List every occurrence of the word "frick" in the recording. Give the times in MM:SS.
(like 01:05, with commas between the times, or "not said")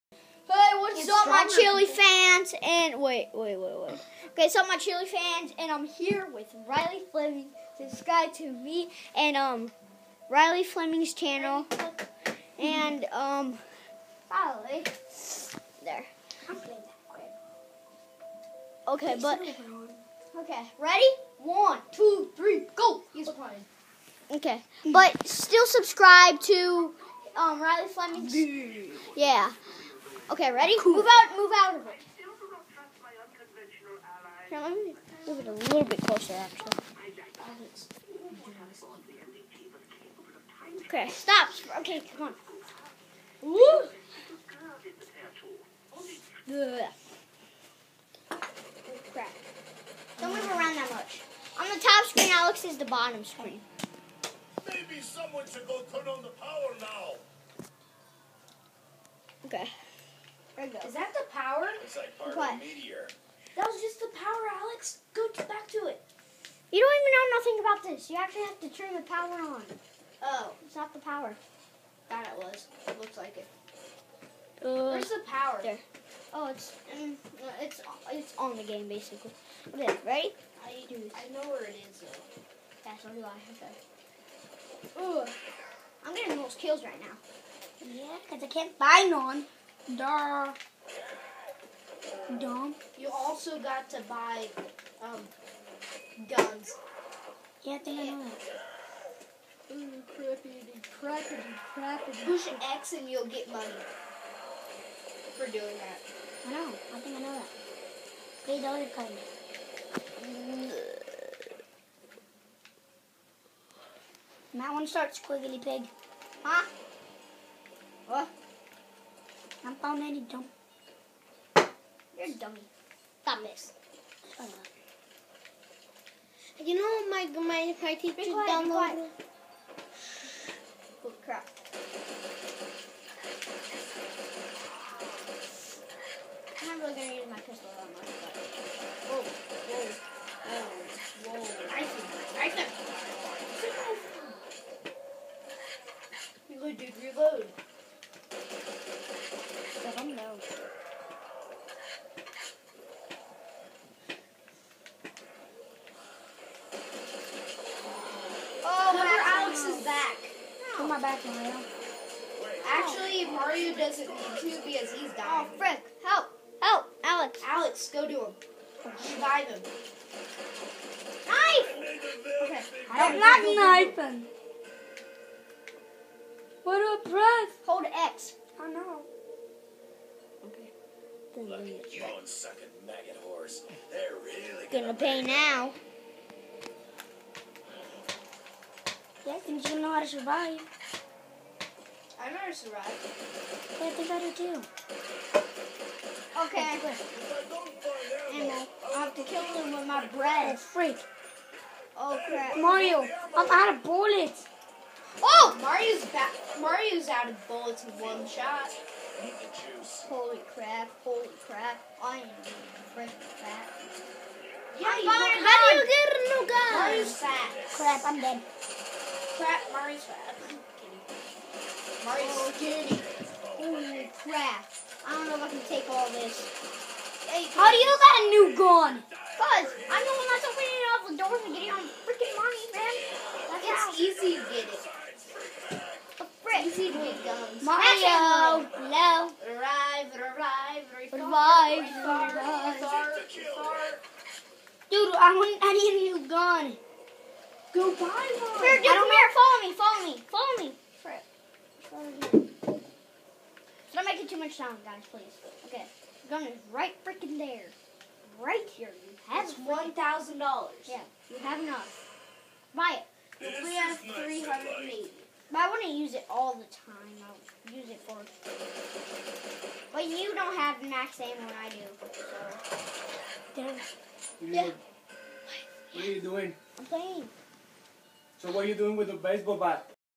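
02:45, 04:12.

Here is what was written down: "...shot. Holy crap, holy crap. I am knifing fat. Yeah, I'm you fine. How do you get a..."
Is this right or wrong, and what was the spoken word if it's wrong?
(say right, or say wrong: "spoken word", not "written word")
wrong: "freaking", not "knifing".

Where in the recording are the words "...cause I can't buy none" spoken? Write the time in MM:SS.
01:28.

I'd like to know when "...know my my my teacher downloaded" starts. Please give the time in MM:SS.
02:06.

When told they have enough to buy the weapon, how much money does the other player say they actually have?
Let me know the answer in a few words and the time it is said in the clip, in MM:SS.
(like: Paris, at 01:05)
380, at 04:23.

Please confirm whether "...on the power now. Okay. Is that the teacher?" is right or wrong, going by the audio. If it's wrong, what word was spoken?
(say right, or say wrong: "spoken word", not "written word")
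wrong: "power", not "teacher".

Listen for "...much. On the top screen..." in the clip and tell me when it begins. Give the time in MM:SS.
00:50.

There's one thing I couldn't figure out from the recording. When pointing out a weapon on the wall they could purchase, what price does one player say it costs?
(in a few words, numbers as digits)
$1,000.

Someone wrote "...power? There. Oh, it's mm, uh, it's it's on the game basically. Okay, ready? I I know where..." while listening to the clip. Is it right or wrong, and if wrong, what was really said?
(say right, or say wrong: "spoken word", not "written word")
right.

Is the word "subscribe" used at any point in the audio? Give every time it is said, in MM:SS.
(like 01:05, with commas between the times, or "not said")
00:07, 00:25.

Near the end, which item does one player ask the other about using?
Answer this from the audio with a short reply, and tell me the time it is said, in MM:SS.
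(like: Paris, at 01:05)
baseball bat, at 04:39.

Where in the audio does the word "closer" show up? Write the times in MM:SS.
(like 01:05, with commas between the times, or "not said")
00:36.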